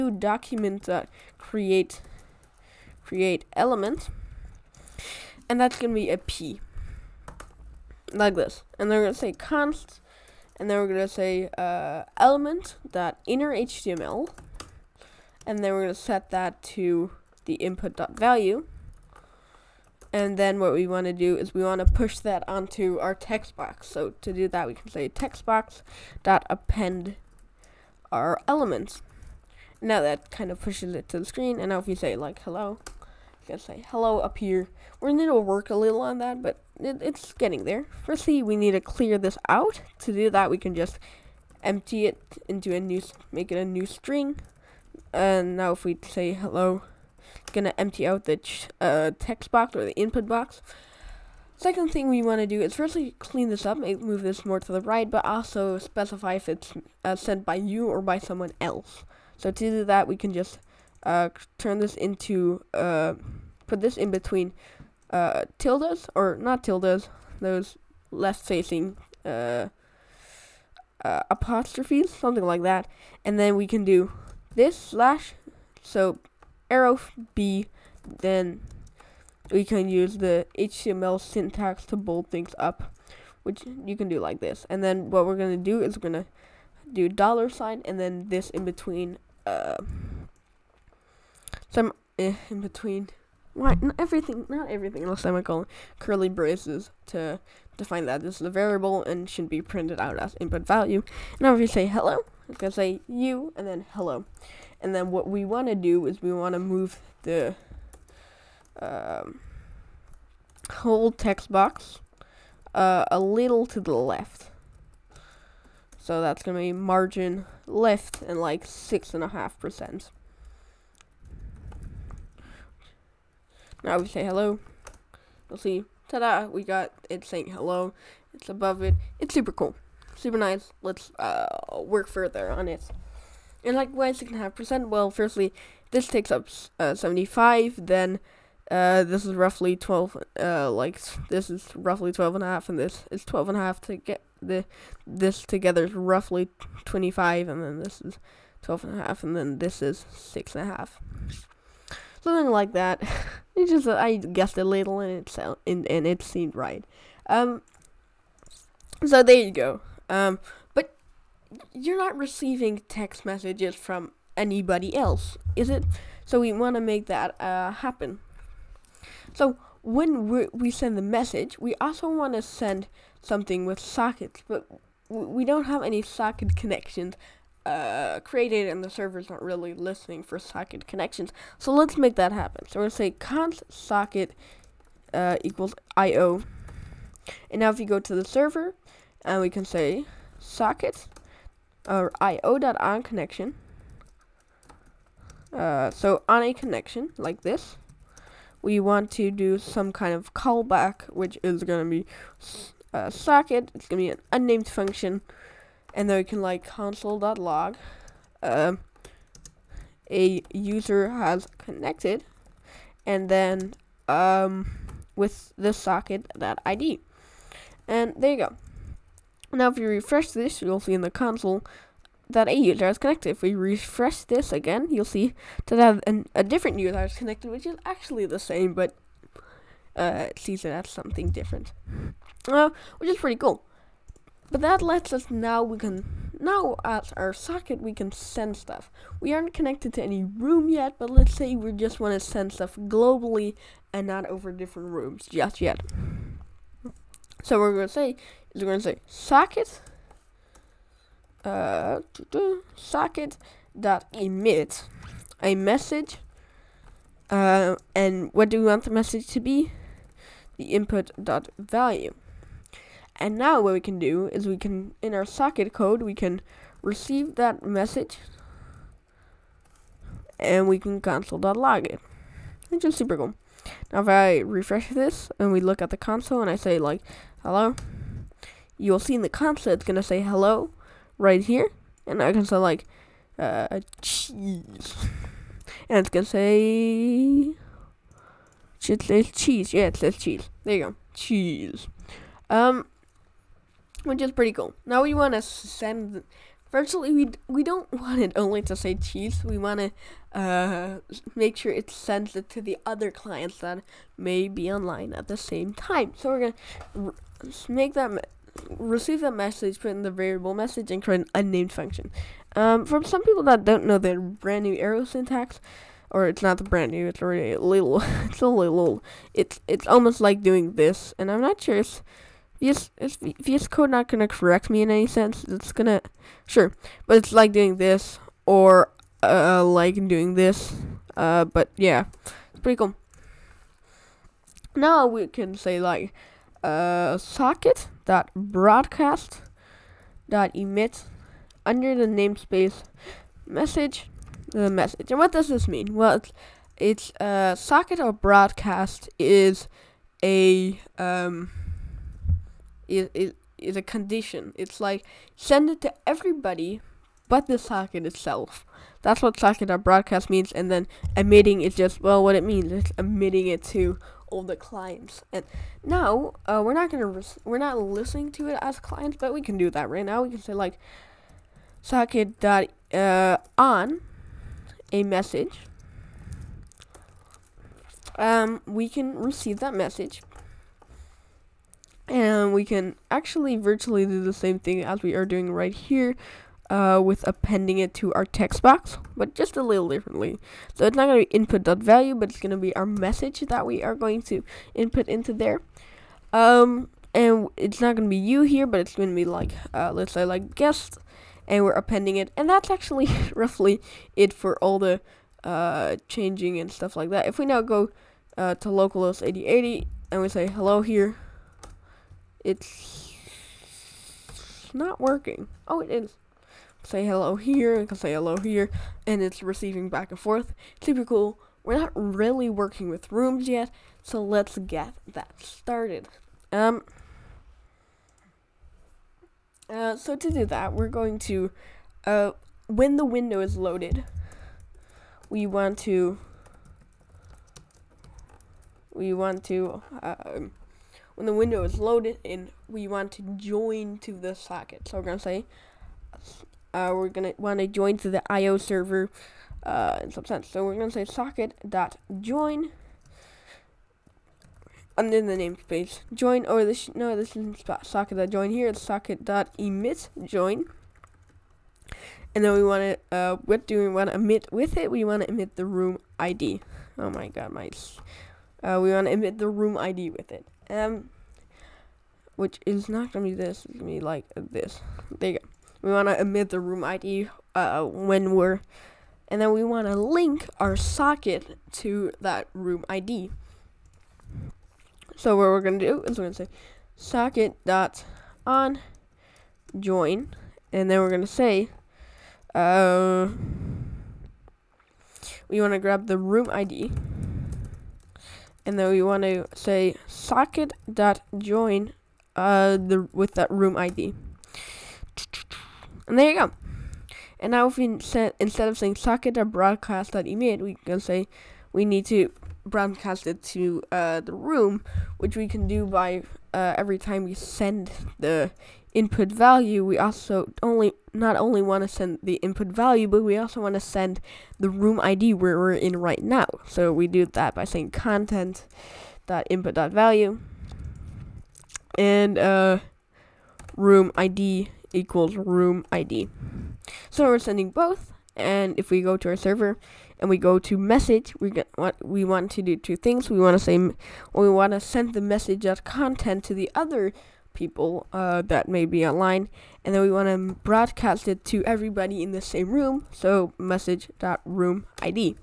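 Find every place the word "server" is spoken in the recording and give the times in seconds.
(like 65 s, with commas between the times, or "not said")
178 s, 188 s, 448 s, 539 s.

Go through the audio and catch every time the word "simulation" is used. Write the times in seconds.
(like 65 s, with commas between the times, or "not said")
not said.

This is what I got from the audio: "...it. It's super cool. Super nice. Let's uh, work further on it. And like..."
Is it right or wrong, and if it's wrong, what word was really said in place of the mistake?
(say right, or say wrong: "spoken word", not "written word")
right.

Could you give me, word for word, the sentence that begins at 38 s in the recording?
Firstly, we need to clear this out.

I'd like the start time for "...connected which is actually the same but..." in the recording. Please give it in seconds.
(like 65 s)
227 s.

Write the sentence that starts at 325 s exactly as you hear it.
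It's gonna, sure, but it's like doing this or uh, like doing this.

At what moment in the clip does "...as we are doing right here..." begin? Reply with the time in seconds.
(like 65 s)
384 s.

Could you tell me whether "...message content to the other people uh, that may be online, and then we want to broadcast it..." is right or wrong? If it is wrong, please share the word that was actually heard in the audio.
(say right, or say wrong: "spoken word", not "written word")
right.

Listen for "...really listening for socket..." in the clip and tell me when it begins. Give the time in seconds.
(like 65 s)
179 s.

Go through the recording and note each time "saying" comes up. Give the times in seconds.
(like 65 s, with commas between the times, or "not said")
127 s, 508 s, 527 s.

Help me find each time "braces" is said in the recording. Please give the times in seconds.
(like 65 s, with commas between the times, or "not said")
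96 s.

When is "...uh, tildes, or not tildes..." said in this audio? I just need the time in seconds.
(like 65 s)
65 s.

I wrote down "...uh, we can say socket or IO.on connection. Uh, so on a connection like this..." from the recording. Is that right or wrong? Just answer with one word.
right.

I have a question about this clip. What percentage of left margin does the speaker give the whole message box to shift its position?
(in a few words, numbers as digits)
6.5%.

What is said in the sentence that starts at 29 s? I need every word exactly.
Now that kind of pushes it to the screen.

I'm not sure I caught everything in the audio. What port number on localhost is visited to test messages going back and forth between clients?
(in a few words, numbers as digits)
8080.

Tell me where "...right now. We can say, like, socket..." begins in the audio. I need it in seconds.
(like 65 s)
369 s.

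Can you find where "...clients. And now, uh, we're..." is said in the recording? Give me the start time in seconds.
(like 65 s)
364 s.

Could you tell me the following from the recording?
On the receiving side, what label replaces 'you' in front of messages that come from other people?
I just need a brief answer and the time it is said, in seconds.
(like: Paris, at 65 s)
guest, at 400 s.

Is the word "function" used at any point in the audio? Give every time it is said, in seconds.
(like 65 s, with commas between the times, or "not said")
204 s, 311 s.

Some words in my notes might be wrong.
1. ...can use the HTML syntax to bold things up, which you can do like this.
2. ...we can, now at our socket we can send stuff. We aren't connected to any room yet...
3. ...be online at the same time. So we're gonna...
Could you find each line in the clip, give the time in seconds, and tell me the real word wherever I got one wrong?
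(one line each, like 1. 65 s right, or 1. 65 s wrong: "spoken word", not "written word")
1. 79 s right
2. 235 s right
3. 304 s right.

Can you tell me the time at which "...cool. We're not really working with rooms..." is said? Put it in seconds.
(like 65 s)
421 s.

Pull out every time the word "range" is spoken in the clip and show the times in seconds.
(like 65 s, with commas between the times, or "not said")
not said.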